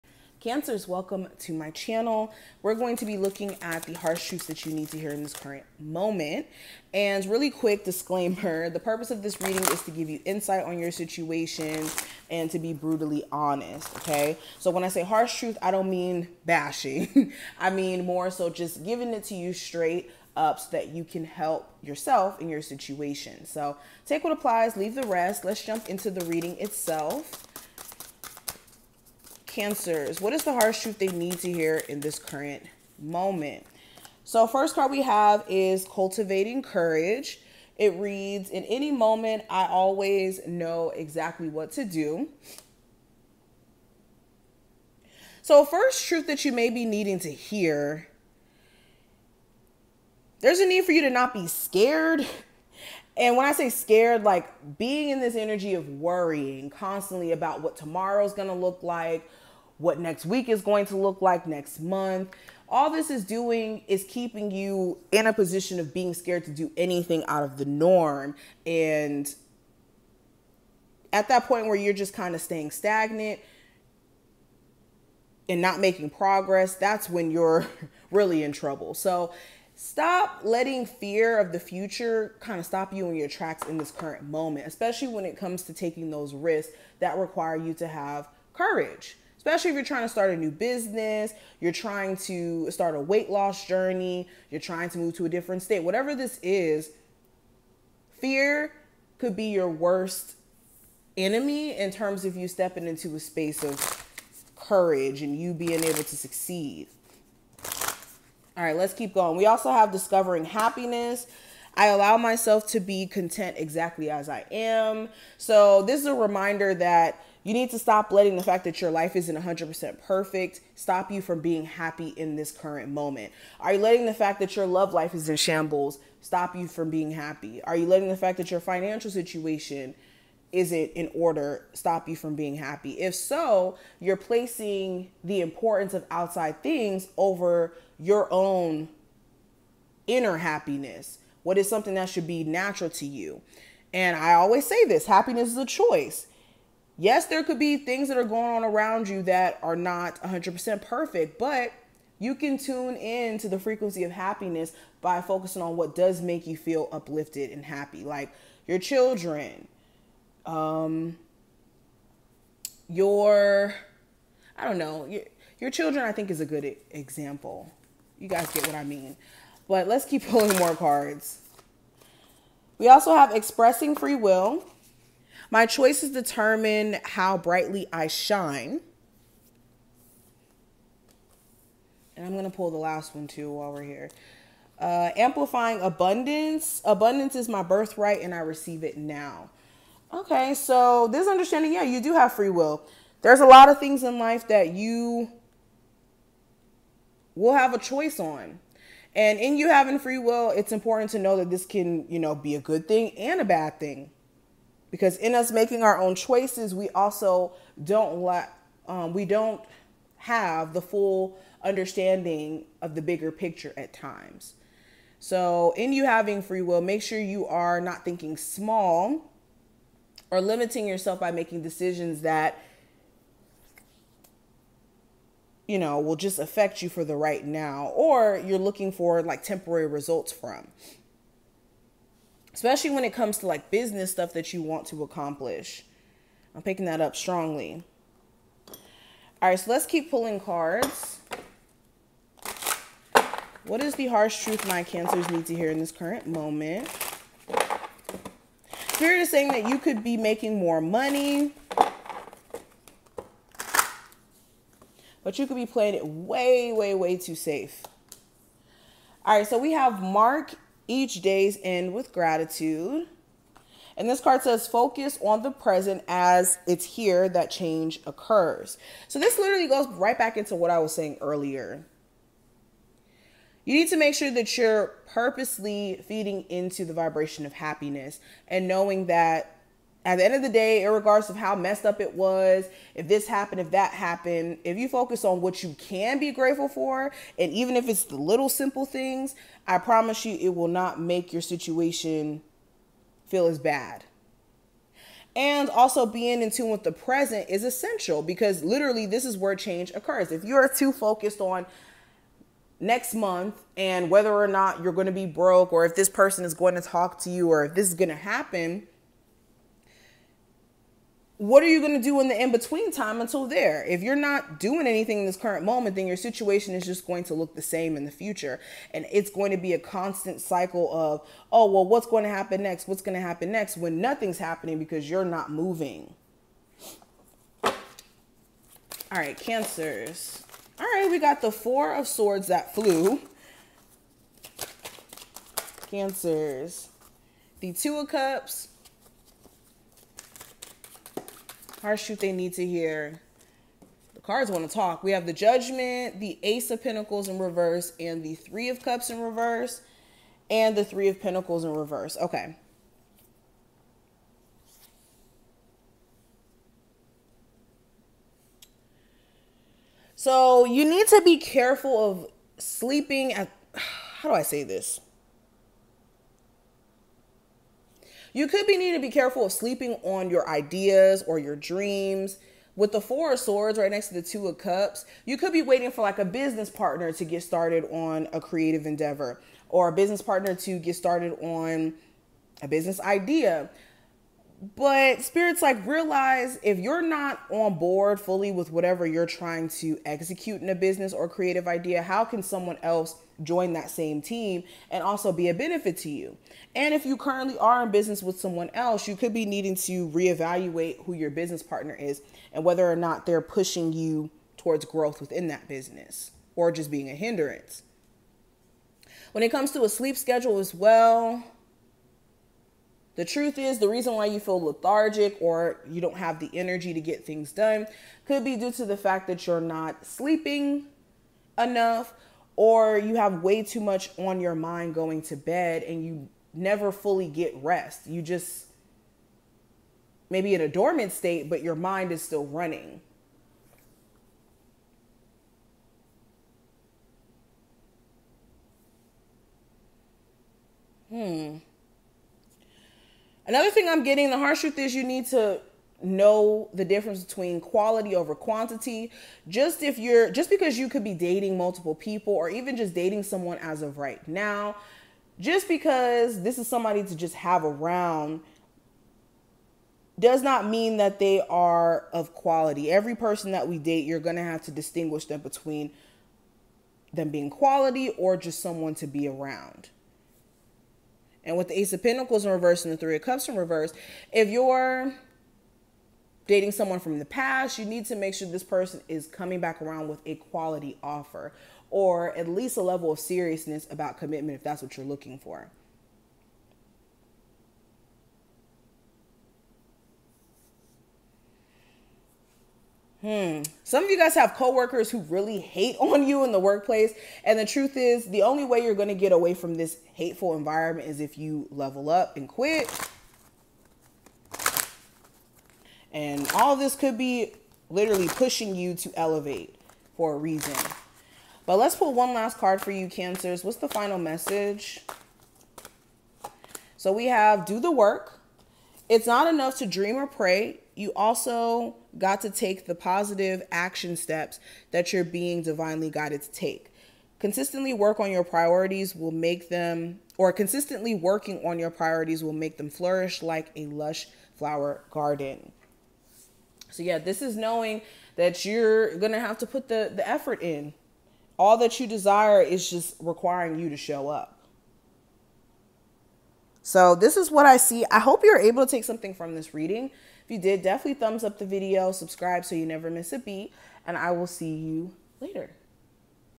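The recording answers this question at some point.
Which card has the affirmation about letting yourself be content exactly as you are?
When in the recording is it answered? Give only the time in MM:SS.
01:49.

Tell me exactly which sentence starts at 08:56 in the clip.
So, yeah, this is knowing that you're going to have to put the, the effort in.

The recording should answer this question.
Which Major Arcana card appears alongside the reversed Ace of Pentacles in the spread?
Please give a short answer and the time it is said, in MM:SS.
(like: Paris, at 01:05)
Judgment, at 05:45.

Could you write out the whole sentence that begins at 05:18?
And it's going to be a constant cycle of, oh, well, what's going to happen next?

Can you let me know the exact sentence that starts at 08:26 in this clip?
And all this could be literally pushing you to elevate for a reason.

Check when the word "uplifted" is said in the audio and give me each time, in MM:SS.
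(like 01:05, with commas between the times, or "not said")
02:36.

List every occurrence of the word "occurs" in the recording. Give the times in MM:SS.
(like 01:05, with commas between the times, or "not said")
04:28, 04:59.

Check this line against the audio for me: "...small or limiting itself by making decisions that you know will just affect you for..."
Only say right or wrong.
wrong.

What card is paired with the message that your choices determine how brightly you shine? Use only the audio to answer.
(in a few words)
Expressing free will.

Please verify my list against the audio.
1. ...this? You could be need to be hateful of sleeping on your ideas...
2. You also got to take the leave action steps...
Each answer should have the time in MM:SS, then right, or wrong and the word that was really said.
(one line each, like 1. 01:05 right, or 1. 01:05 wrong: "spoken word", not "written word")
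1. 06:04 wrong: "careful", not "hateful"
2. 08:40 wrong: "positive", not "leave".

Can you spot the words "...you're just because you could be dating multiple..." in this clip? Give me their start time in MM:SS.
07:29.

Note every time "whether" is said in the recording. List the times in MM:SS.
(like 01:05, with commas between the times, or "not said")
05:04, 06:42.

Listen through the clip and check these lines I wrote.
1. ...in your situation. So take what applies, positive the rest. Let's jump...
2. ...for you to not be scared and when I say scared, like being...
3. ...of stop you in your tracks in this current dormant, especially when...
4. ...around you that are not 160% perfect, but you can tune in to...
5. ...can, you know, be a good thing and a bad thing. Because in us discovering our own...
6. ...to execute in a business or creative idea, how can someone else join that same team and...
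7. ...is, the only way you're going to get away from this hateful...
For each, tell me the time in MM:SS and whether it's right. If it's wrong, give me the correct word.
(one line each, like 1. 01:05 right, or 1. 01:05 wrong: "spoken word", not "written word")
1. 00:22 wrong: "leave", not "positive"
2. 00:50 right
3. 01:22 wrong: "moment", not "dormant"
4. 02:28 wrong: "100", not "160"
5. 03:21 wrong: "making", not "discovering"
6. 06:29 right
7. 08:17 right.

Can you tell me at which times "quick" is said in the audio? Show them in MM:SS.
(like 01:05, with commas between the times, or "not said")
00:07.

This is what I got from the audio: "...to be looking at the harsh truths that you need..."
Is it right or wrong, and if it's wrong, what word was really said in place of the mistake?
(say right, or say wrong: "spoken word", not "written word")
right.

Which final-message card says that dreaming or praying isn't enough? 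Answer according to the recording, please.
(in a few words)
Do the work.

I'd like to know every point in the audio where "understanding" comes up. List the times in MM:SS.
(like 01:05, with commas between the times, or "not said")
03:11, 03:31.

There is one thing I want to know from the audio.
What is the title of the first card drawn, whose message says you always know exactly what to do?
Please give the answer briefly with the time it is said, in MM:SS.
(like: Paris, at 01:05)
Cultivating Courage, at 00:35.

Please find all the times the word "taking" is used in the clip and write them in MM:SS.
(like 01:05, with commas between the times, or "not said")
01:25.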